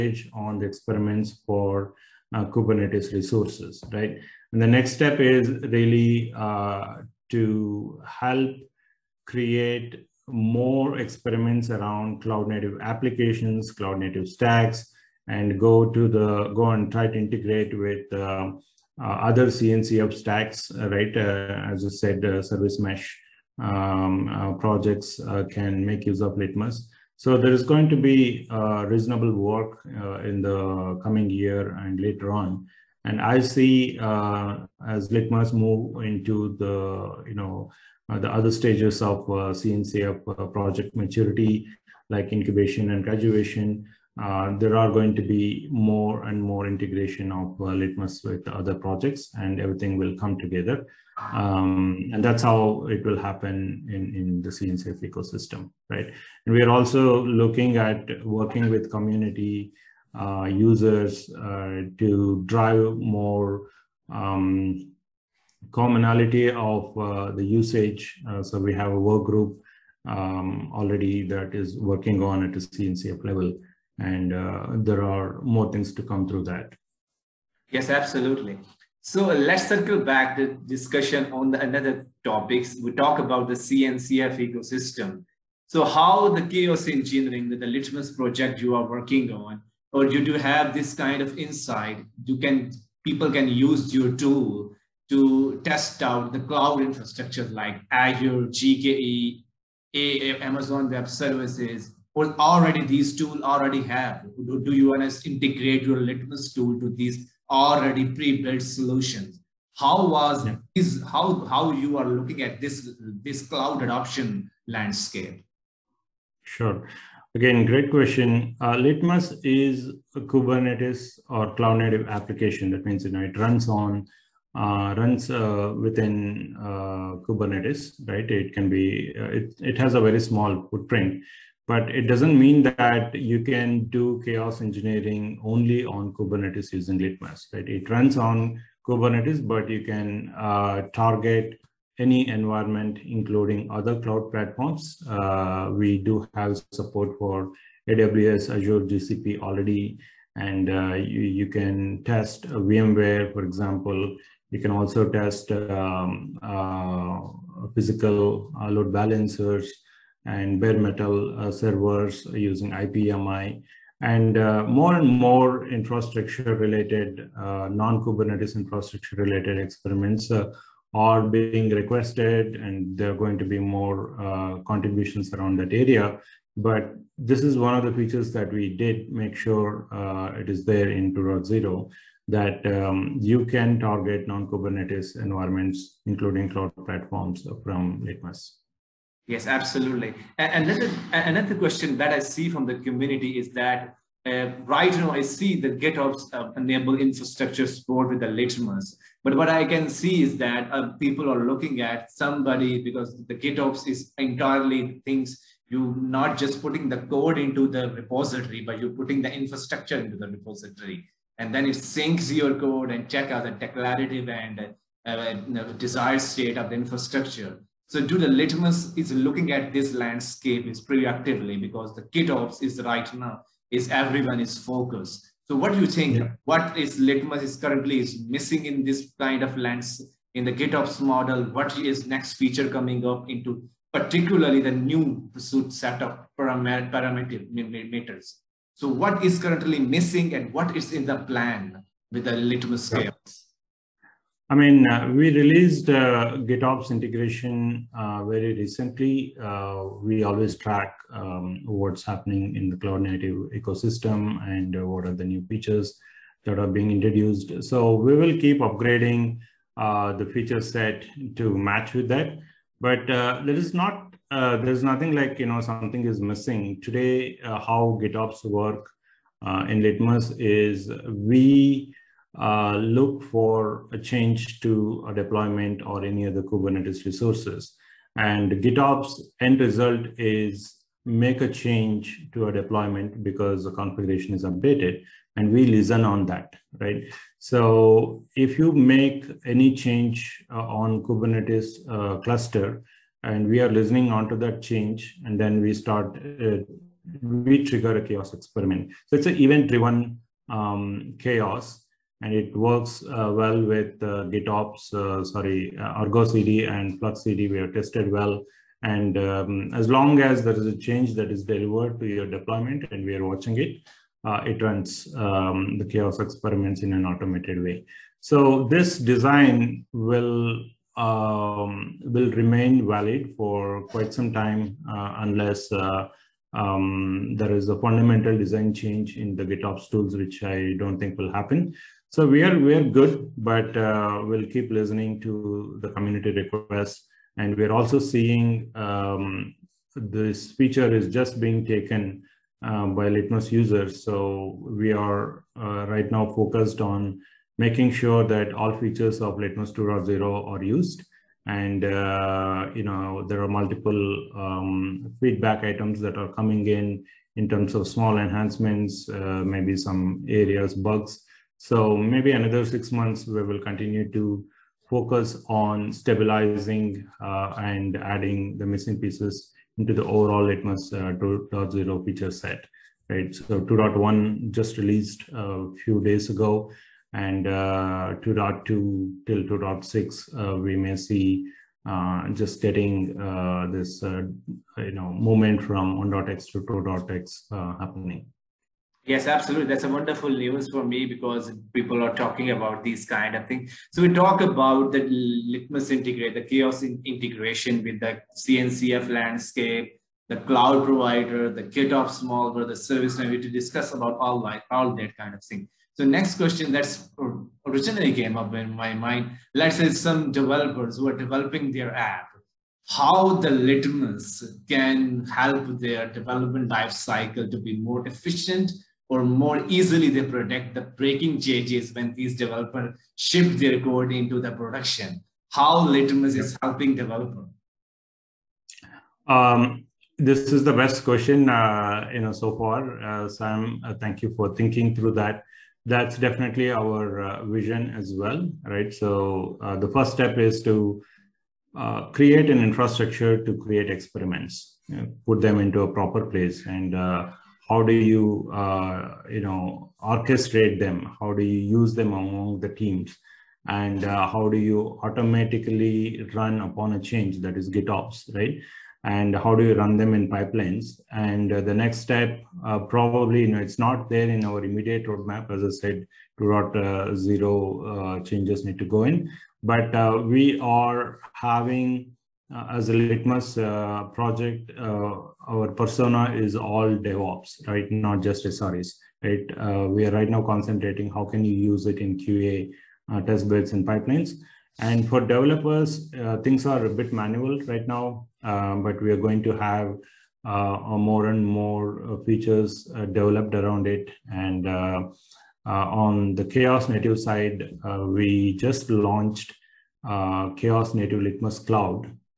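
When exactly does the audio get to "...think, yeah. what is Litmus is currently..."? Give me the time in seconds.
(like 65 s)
225 s.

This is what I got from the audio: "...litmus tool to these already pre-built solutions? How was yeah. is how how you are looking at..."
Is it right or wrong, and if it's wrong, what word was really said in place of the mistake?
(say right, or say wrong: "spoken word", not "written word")
right.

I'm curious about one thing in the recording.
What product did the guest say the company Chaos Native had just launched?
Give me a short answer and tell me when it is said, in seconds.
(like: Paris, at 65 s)
Chaos Native Litmus Cloud, at 500 s.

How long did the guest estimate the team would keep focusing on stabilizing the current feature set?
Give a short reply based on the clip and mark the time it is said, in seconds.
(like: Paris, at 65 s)
6 months, at 362 s.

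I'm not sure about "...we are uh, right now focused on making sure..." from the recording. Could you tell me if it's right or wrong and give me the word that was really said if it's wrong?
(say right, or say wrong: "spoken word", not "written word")
right.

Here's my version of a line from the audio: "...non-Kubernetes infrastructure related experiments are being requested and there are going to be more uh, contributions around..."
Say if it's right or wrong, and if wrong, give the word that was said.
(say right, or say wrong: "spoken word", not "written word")
right.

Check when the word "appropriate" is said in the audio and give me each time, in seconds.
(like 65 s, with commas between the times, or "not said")
not said.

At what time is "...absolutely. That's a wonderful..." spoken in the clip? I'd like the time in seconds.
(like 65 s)
389 s.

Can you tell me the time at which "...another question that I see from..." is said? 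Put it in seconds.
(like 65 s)
191 s.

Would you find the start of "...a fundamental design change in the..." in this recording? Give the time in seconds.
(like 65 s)
327 s.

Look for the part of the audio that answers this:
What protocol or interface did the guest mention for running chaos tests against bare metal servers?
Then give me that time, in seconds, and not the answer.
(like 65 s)
162 s.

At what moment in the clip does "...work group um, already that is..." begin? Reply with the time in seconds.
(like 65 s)
69 s.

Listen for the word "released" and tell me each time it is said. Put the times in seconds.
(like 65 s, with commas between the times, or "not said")
245 s, 374 s.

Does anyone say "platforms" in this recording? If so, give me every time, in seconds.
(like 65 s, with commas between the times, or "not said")
144 s, 186 s.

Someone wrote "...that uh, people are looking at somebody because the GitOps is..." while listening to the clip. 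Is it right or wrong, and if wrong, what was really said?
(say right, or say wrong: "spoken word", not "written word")
right.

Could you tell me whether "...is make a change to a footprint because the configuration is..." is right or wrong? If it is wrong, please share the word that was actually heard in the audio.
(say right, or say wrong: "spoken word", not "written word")
wrong: "deployment", not "footprint".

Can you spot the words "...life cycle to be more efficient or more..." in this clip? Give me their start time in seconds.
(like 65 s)
416 s.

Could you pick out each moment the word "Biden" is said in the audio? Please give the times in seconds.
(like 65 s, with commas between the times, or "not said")
not said.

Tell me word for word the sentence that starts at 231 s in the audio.
What is next feature coming up into particularly the new pursuit set of paramet parameters?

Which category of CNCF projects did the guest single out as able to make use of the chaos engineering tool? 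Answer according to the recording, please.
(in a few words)
Service mesh.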